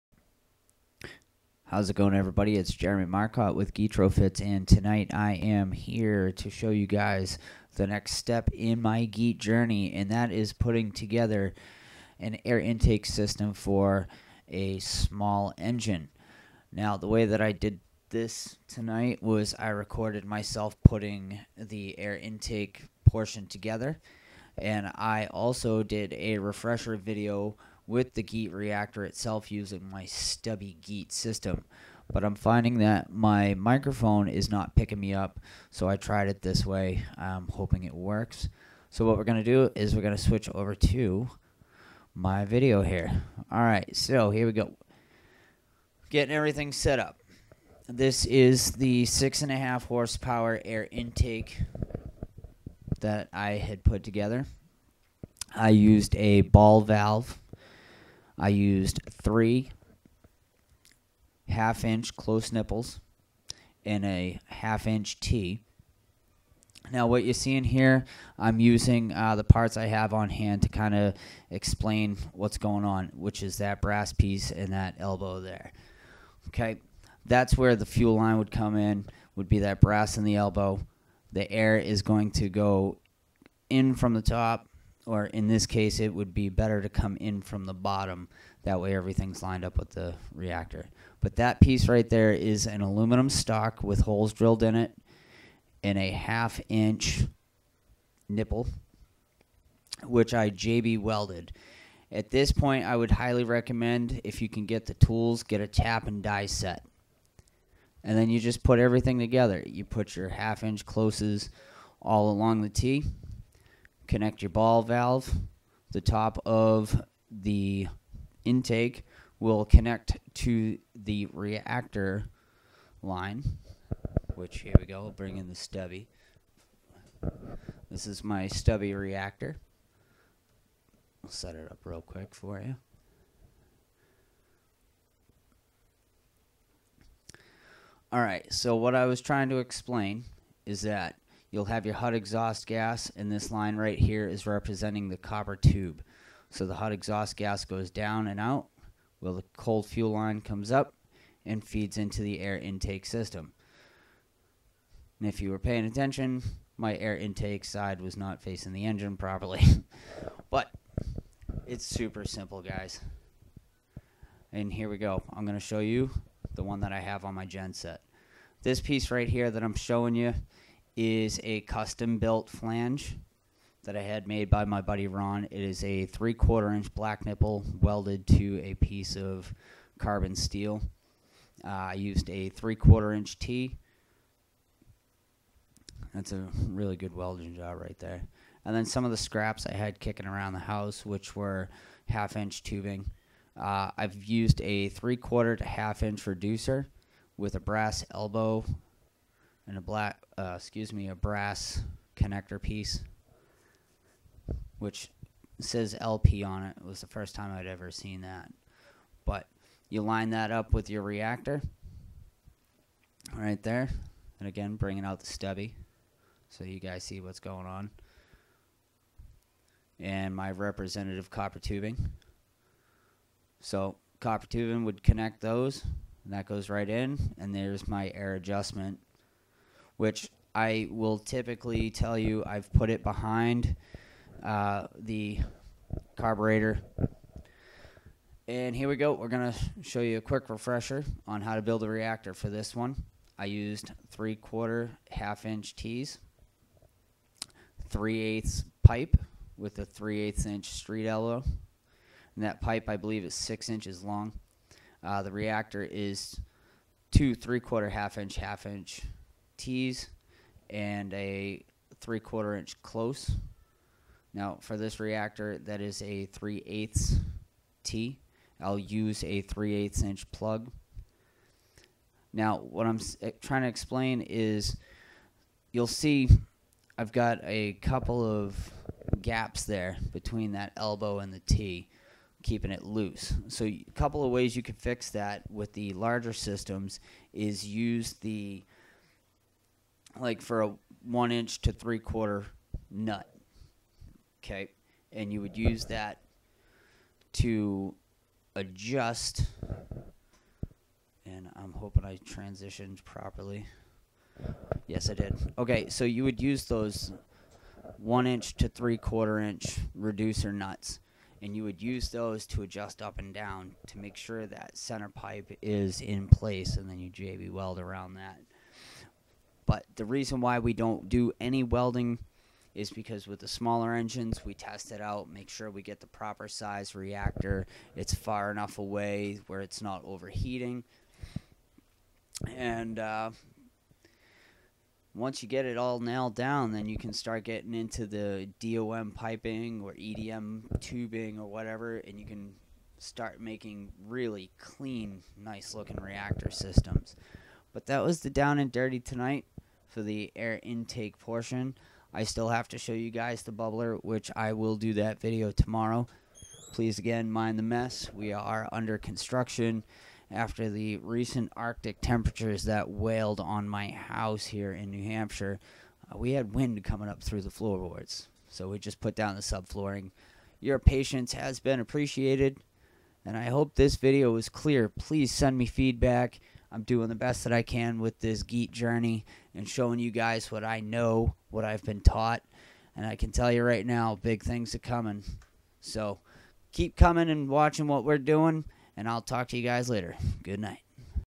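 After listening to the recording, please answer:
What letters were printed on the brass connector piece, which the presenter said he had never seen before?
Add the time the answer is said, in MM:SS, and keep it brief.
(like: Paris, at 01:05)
LP, at 03:26.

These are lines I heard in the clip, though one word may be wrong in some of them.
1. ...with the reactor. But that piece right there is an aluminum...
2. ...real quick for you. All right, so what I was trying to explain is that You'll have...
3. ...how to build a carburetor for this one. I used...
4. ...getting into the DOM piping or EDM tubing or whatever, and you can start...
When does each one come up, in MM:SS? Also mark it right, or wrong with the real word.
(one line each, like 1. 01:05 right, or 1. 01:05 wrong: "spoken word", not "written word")
1. 01:29 right
2. 02:11 right
3. 04:01 wrong: "reactor", not "carburetor"
4. 05:37 right.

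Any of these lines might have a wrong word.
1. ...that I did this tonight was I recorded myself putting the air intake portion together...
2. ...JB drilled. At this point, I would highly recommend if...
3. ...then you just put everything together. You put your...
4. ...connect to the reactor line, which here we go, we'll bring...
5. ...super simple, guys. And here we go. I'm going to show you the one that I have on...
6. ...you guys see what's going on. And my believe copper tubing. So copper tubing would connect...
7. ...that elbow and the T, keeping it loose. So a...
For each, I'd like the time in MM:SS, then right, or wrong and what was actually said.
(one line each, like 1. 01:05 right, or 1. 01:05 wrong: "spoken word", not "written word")
1. 00:17 right
2. 01:40 wrong: "welded", not "drilled"
3. 01:48 right
4. 01:59 right
5. 02:41 right
6. 03:36 wrong: "representative", not "believe"
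7. 04:40 right.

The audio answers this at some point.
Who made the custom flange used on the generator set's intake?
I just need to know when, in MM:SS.
02:55.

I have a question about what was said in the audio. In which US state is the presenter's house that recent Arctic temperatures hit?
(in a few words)
New Hampshire.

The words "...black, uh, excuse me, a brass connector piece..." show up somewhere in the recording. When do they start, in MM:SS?
03:19.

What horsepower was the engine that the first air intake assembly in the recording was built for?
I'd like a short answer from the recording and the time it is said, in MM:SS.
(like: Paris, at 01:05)
6.5, at 00:49.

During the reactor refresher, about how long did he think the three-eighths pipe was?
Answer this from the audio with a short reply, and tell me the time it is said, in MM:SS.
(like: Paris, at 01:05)
6 inches, at 04:13.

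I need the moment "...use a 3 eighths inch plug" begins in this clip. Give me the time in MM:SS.
04:28.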